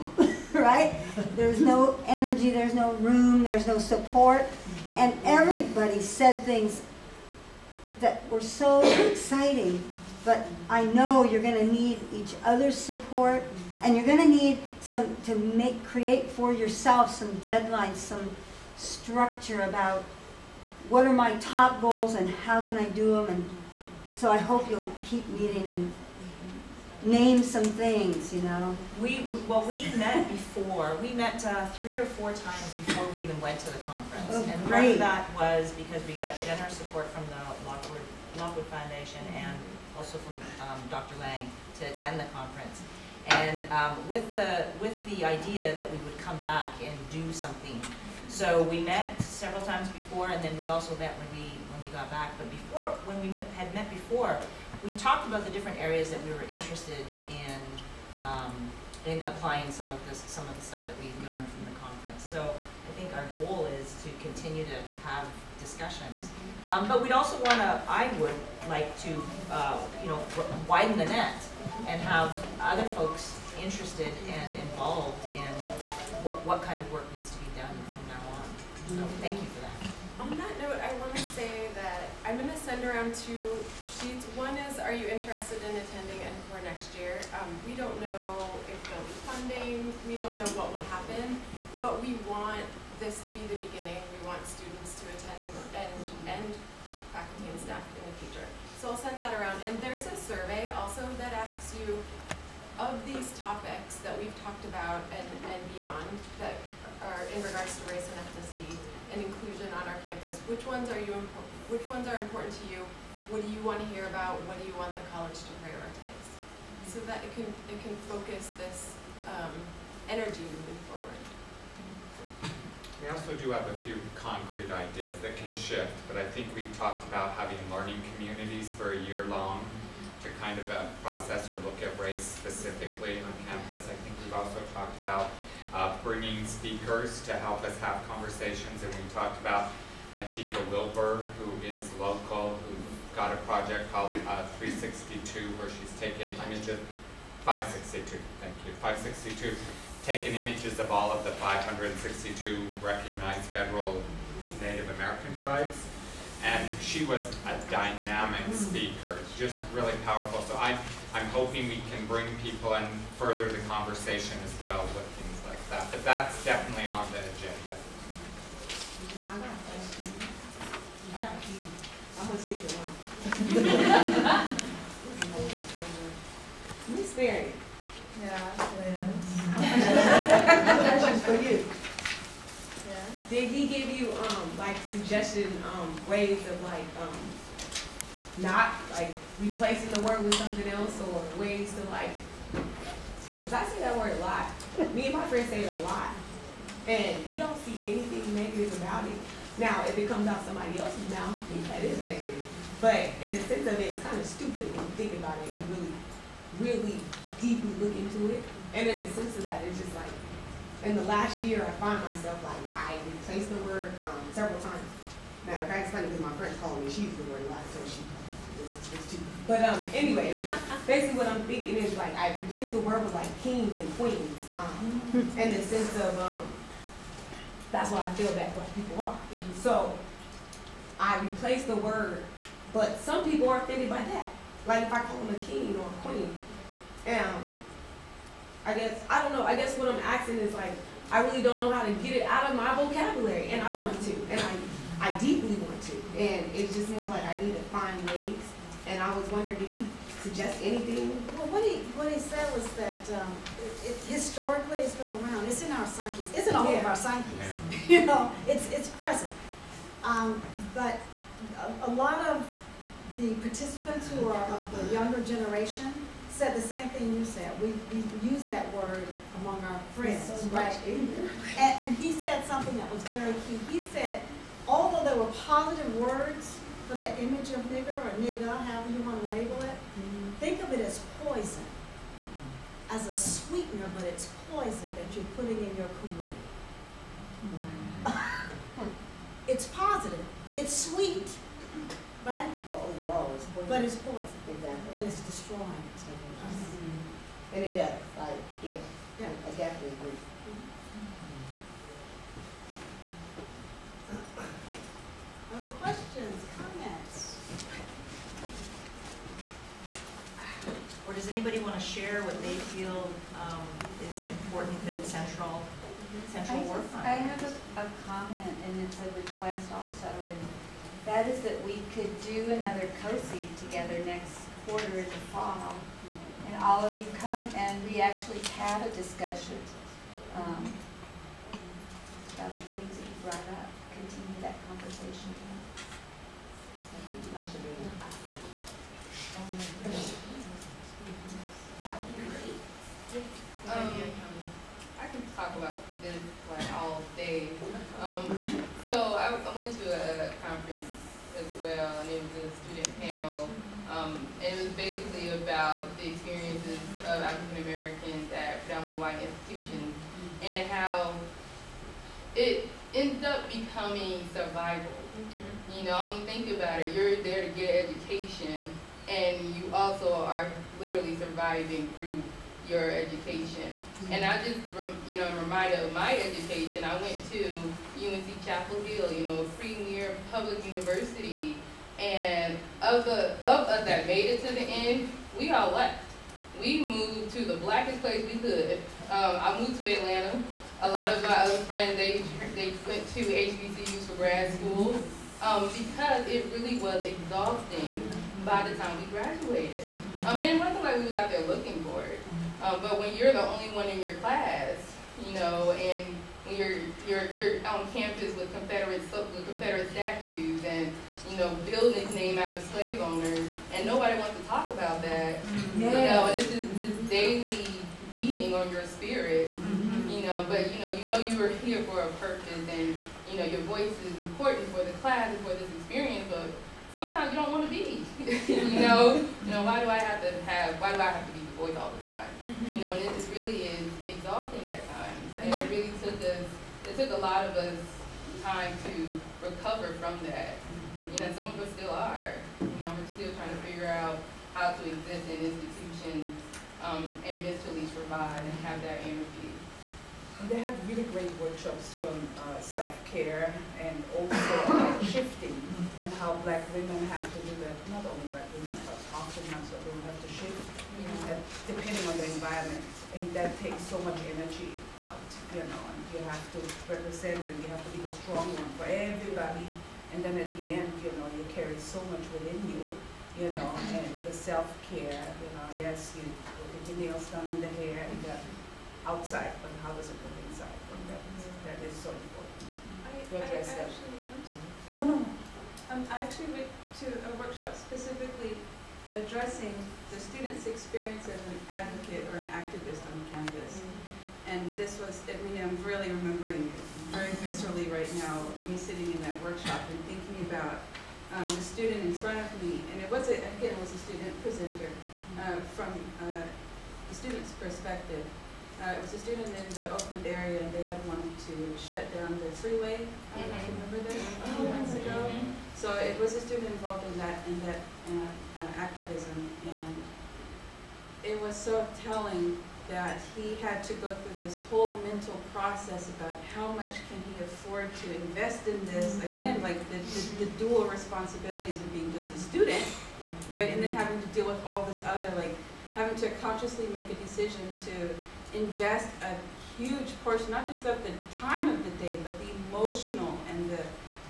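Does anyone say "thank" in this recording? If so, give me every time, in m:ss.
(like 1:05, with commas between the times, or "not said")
1:19, 2:28.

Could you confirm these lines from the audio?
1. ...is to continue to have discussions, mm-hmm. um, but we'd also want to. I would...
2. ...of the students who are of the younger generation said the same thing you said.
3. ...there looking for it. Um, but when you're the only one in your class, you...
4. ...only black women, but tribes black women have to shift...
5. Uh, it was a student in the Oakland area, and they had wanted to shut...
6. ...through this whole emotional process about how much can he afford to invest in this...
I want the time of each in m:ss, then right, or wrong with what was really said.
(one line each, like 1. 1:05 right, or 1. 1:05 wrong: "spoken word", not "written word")
1. 1:03 right
2. 4:22 wrong: "participants", not "students"
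3. 6:41 right
4. 7:38 wrong: "oftentimes", not "tribes"
5. 8:28 right
6. 8:44 wrong: "mental", not "emotional".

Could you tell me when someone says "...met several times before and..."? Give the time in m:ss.
0:48.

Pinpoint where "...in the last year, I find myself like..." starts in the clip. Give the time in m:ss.
3:30.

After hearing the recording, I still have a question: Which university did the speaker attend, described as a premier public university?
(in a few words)
UNC Chapel Hill.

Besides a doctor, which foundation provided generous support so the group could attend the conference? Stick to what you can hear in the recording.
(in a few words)
Lockwood Foundation.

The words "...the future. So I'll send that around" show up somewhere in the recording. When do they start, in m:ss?
1:38.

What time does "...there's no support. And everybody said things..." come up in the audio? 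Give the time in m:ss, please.
0:03.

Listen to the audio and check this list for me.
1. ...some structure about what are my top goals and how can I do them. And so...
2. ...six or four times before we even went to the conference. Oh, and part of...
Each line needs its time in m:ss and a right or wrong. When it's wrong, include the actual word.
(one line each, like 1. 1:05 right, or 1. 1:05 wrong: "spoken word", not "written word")
1. 0:17 right
2. 0:31 wrong: "three", not "six".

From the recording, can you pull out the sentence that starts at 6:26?
We moved to the blackest place we could.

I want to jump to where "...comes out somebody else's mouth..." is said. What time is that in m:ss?
3:20.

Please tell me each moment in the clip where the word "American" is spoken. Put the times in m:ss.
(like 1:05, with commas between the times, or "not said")
2:34, 5:57.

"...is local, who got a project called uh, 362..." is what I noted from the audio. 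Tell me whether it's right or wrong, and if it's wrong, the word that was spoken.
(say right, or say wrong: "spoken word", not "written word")
right.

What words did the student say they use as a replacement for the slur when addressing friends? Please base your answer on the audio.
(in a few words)
kings and queens.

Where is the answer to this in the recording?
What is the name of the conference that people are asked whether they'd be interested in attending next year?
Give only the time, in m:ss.
1:26.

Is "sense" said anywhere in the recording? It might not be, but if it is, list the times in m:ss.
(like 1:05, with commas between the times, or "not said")
3:23, 3:29, 3:45.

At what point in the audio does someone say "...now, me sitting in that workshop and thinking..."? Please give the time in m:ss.
8:18.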